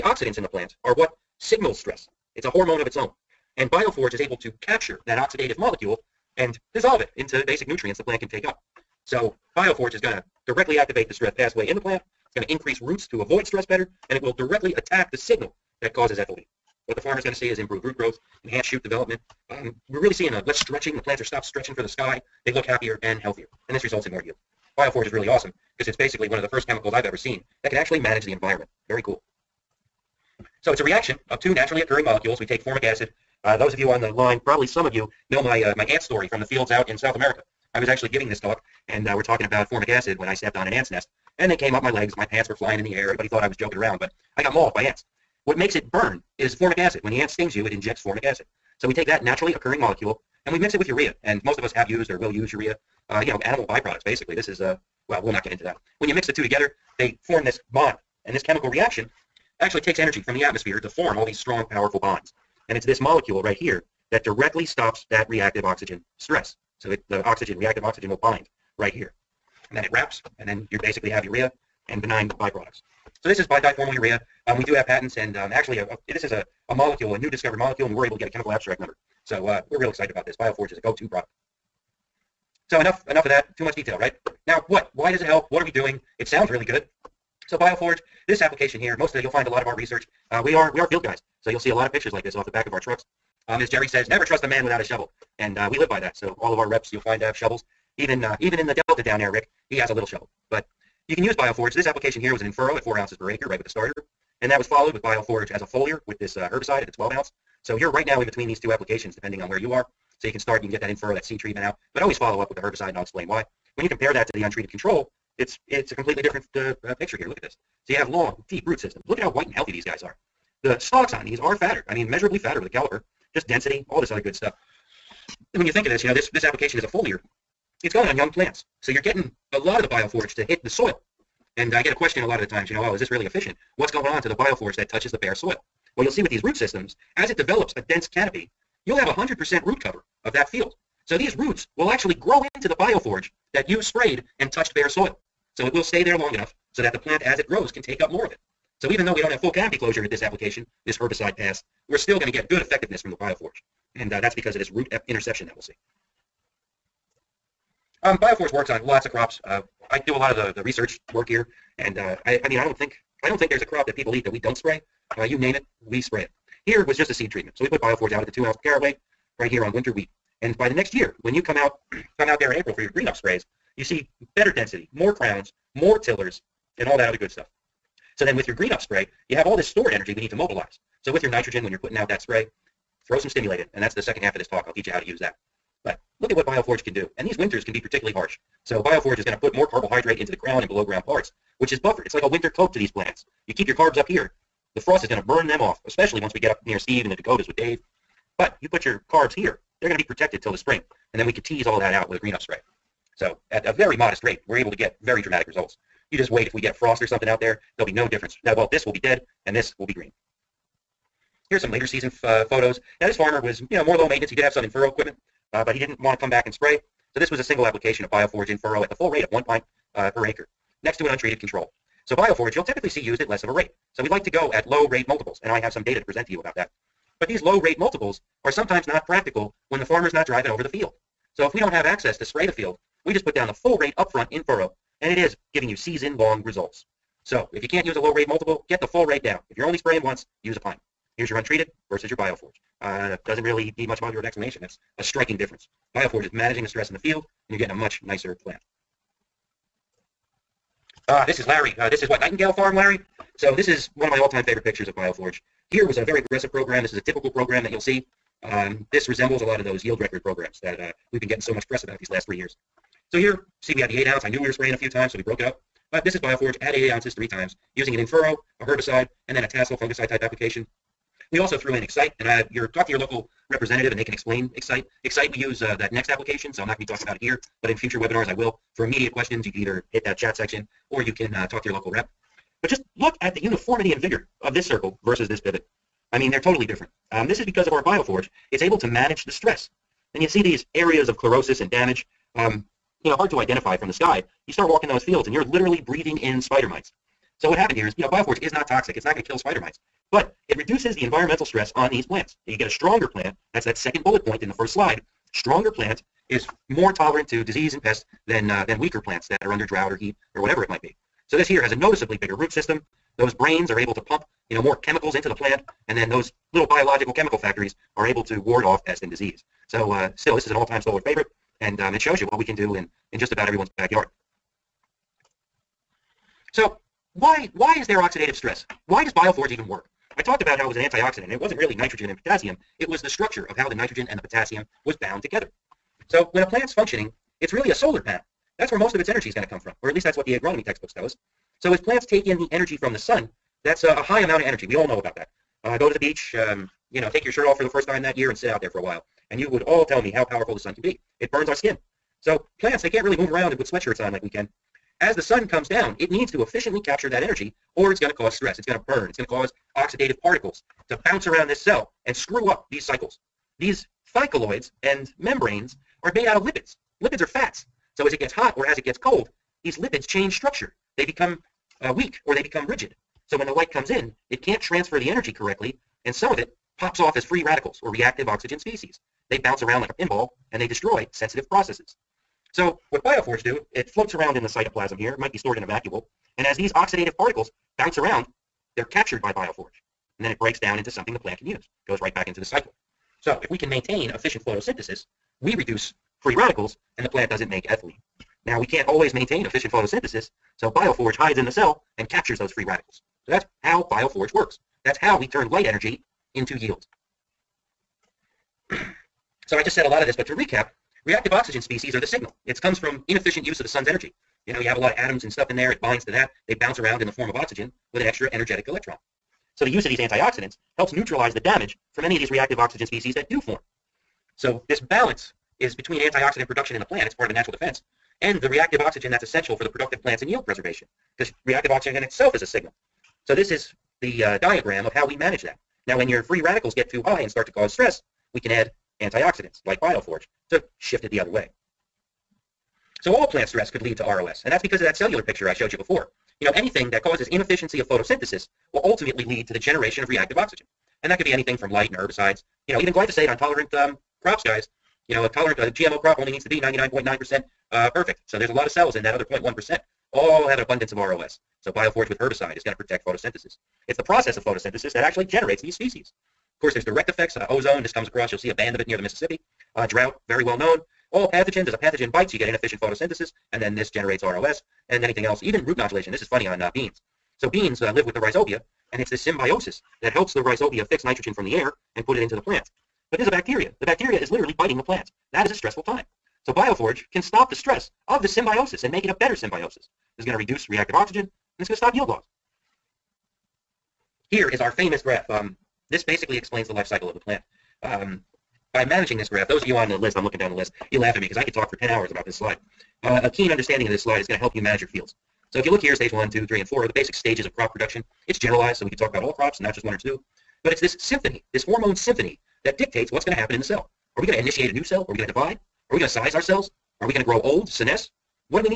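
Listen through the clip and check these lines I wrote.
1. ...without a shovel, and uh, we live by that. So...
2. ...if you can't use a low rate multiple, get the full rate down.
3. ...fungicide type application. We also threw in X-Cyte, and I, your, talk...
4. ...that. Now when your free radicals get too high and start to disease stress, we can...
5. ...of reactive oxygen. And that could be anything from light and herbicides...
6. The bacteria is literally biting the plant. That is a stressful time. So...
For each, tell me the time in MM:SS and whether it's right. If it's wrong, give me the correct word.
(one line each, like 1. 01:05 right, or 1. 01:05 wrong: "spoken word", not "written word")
1. 01:34 right
2. 03:57 right
3. 04:29 right
4. 07:15 wrong: "cause", not "disease"
5. 07:30 right
6. 08:03 right.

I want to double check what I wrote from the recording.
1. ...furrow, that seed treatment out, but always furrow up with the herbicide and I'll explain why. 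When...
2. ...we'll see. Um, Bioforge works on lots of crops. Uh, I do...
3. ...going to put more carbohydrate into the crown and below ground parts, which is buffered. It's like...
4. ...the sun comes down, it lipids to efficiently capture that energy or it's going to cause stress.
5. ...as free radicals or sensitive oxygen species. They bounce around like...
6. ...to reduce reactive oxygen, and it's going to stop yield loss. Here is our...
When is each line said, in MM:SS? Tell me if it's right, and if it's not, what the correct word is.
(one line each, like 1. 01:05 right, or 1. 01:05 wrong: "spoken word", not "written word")
1. 01:50 wrong: "follow", not "furrow"
2. 02:35 right
3. 03:09 right
4. 05:55 wrong: "needs", not "lipids"
5. 06:17 wrong: "reactive", not "sensitive"
6. 08:10 right.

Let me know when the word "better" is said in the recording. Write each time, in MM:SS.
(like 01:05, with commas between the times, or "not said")
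00:13, 02:54, 08:09.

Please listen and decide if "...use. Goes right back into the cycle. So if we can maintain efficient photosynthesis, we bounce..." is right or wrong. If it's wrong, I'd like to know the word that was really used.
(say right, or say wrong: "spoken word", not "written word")
wrong: "reduce", not "bounce".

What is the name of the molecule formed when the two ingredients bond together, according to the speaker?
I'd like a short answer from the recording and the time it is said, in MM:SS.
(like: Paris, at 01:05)
diformyl urea, at 01:13.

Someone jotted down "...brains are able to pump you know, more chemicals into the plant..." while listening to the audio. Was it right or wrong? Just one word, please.
right.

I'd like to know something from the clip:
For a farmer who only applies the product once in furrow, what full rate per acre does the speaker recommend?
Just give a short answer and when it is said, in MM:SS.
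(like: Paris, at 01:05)
1 pint, at 03:39.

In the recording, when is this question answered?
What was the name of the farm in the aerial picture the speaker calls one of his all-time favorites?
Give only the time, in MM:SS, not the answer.
04:12.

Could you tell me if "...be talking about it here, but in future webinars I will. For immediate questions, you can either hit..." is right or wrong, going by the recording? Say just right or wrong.
right.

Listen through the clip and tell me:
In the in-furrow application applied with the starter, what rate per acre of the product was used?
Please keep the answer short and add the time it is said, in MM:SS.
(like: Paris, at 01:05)
4 ounces, at 01:42.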